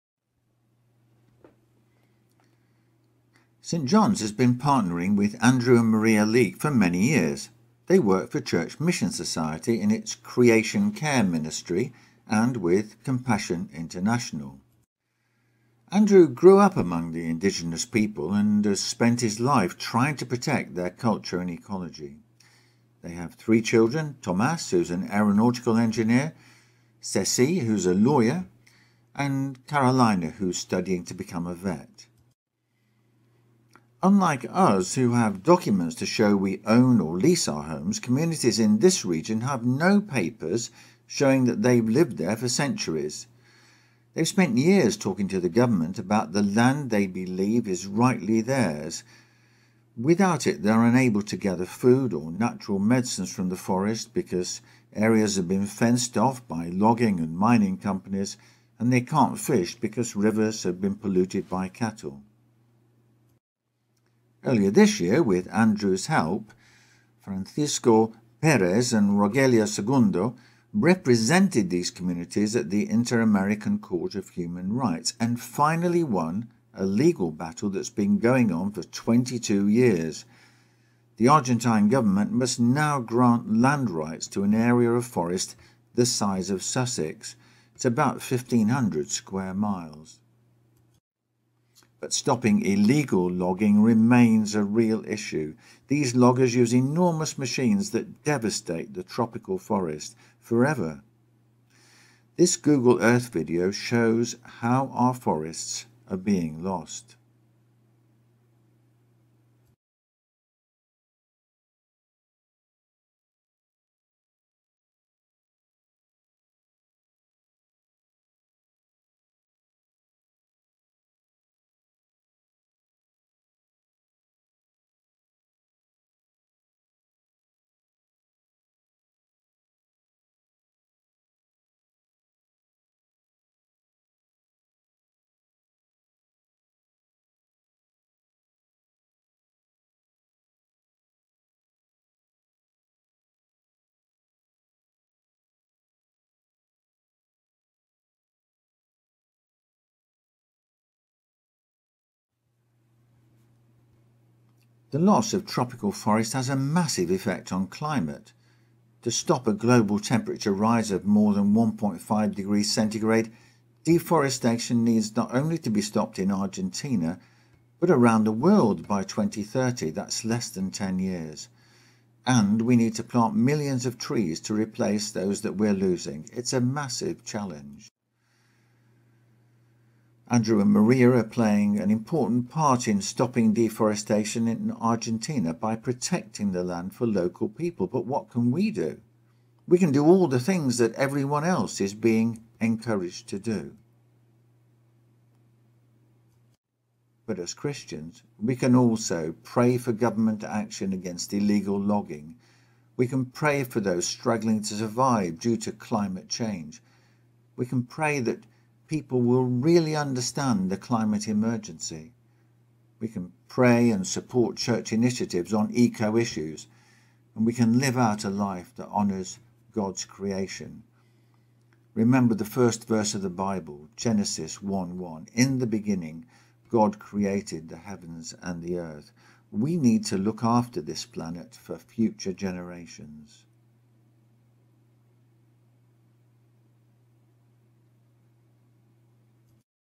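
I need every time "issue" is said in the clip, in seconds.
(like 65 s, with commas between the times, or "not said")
95 s, 216 s.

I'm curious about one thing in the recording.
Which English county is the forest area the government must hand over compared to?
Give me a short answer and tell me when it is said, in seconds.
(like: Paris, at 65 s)
Sussex, at 86 s.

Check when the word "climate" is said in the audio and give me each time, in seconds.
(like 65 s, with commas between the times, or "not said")
157 s, 205 s, 210 s.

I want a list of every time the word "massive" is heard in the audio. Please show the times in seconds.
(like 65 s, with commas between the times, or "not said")
156 s, 176 s.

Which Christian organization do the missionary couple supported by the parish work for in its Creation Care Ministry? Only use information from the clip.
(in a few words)
Church Mission Society.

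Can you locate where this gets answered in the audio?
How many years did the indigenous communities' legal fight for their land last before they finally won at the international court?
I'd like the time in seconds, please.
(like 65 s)
78 s.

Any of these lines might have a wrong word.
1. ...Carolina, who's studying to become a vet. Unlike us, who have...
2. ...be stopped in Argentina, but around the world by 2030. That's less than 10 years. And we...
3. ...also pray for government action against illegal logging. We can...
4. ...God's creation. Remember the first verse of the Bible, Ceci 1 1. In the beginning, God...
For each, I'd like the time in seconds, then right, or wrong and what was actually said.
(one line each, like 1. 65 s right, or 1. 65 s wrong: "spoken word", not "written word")
1. 29 s right
2. 165 s right
3. 198 s right
4. 219 s wrong: "Genesis", not "Ceci".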